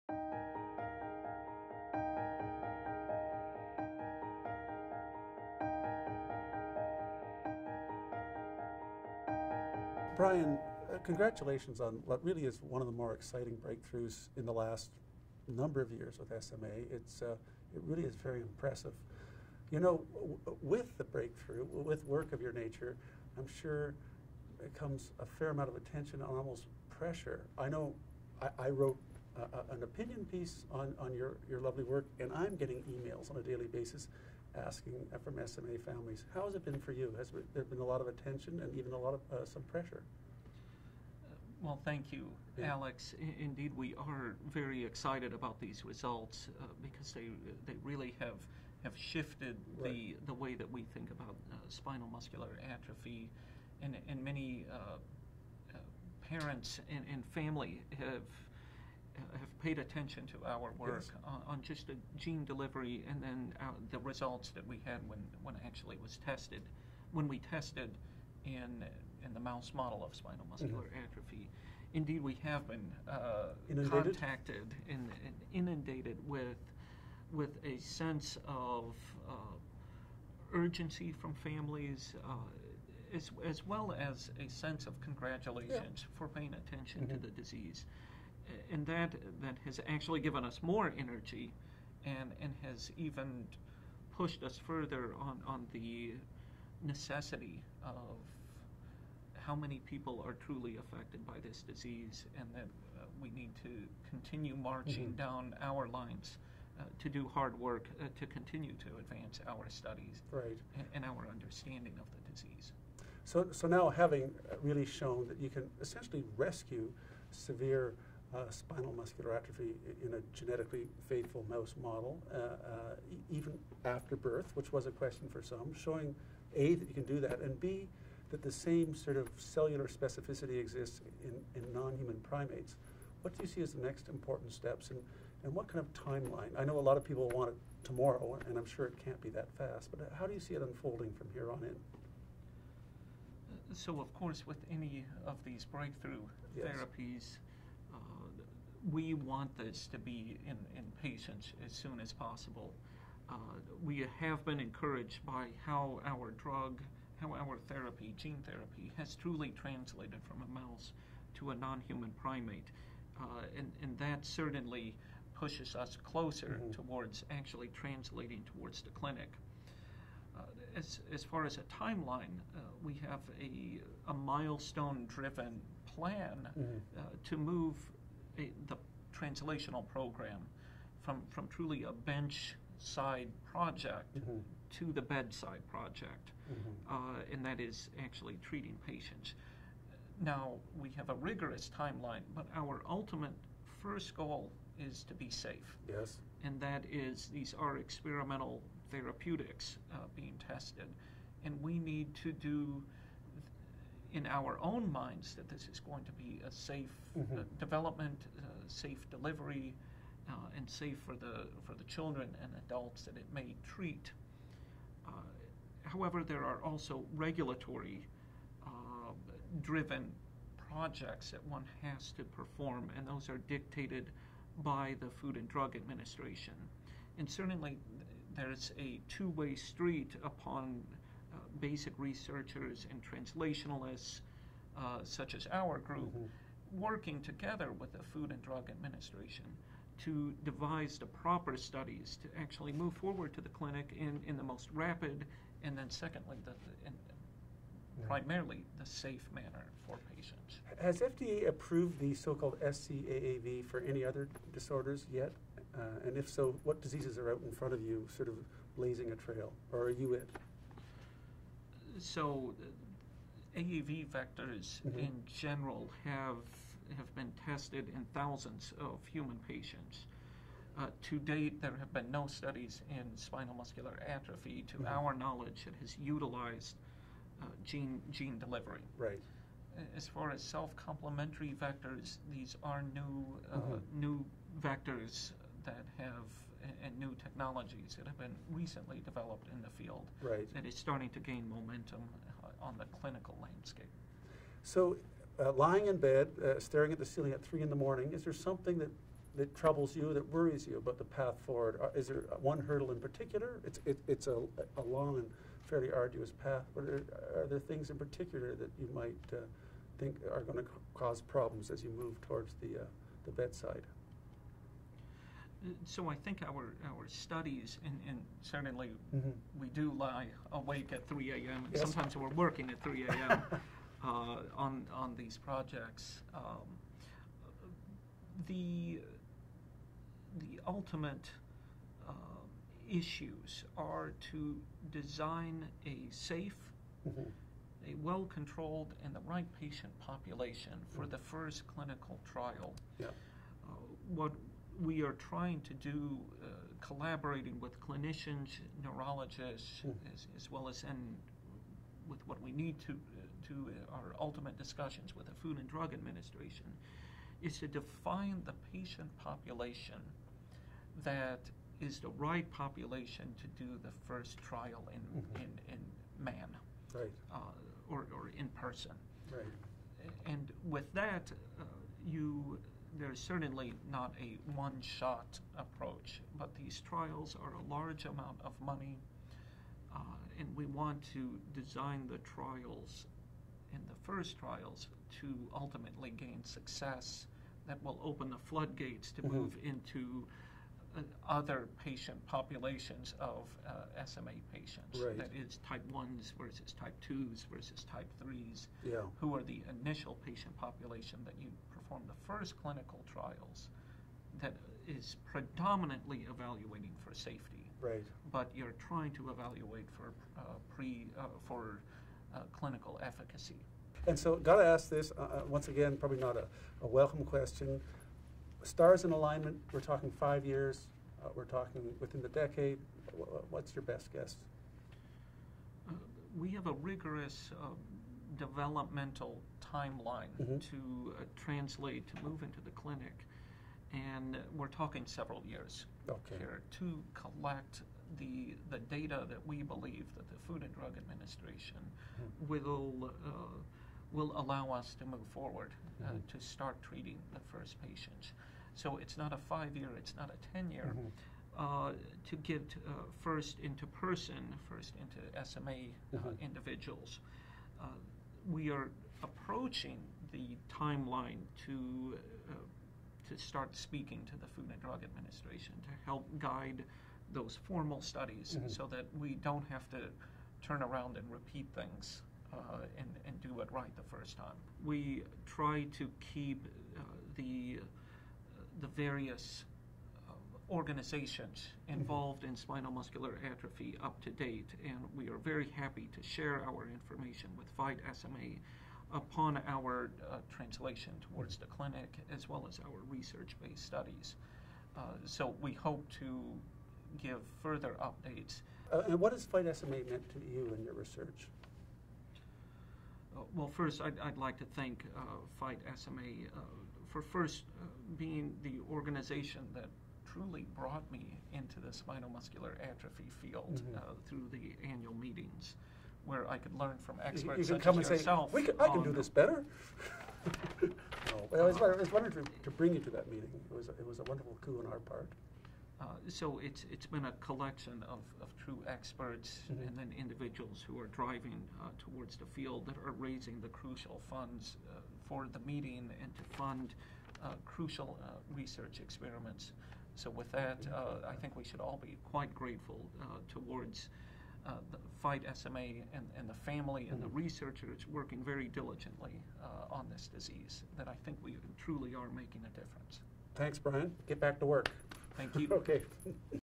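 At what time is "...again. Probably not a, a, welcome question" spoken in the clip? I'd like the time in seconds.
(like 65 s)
415 s.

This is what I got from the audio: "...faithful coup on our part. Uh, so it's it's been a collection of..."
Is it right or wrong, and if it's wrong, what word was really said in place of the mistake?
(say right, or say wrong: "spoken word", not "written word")
wrong: "wonderful", not "faithful".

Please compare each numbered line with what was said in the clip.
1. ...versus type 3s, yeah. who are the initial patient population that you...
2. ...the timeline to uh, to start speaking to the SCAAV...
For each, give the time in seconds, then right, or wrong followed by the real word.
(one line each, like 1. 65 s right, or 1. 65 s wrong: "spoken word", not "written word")
1. 397 s right
2. 460 s wrong: "Food", not "SCAAV".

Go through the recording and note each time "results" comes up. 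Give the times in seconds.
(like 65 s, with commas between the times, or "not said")
45 s, 63 s.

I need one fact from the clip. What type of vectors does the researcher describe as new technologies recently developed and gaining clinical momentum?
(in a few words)
self-complementary vectors.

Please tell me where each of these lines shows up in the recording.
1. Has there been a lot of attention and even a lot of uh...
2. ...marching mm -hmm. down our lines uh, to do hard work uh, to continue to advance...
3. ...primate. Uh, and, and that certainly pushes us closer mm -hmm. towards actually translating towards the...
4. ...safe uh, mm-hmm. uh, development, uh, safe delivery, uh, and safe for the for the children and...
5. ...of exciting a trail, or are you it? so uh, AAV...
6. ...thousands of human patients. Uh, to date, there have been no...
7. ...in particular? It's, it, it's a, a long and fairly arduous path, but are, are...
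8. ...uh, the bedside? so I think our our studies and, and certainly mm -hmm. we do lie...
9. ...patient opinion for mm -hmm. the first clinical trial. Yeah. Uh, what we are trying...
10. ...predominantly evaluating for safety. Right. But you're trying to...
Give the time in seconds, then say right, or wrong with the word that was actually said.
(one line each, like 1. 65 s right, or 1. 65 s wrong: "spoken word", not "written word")
1. 37 s right
2. 104 s right
3. 162 s right
4. 206 s right
5. 258 s wrong: "blazing", not "exciting"
6. 268 s right
7. 302 s right
8. 312 s right
9. 339 s wrong: "population", not "opinion"
10. 405 s right.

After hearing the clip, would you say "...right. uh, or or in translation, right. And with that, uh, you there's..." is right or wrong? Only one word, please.
wrong.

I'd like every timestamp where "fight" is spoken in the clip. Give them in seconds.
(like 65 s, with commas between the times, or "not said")
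487 s, 499 s, 505 s, 545 s.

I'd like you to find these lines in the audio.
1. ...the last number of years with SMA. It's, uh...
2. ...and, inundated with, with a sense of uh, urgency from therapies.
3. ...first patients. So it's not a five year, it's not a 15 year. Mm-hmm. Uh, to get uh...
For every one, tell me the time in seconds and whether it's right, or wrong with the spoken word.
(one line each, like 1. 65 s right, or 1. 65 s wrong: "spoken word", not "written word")
1. 14 s right
2. 75 s wrong: "families", not "therapies"
3. 447 s wrong: "10", not "15".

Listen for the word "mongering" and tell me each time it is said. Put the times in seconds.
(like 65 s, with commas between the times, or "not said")
not said.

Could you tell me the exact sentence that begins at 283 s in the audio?
new vectors that have and new technologies that have been recently developed in the field right.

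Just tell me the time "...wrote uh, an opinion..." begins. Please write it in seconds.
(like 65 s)
28 s.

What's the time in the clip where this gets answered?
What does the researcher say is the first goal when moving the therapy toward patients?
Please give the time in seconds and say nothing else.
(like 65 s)
195 s.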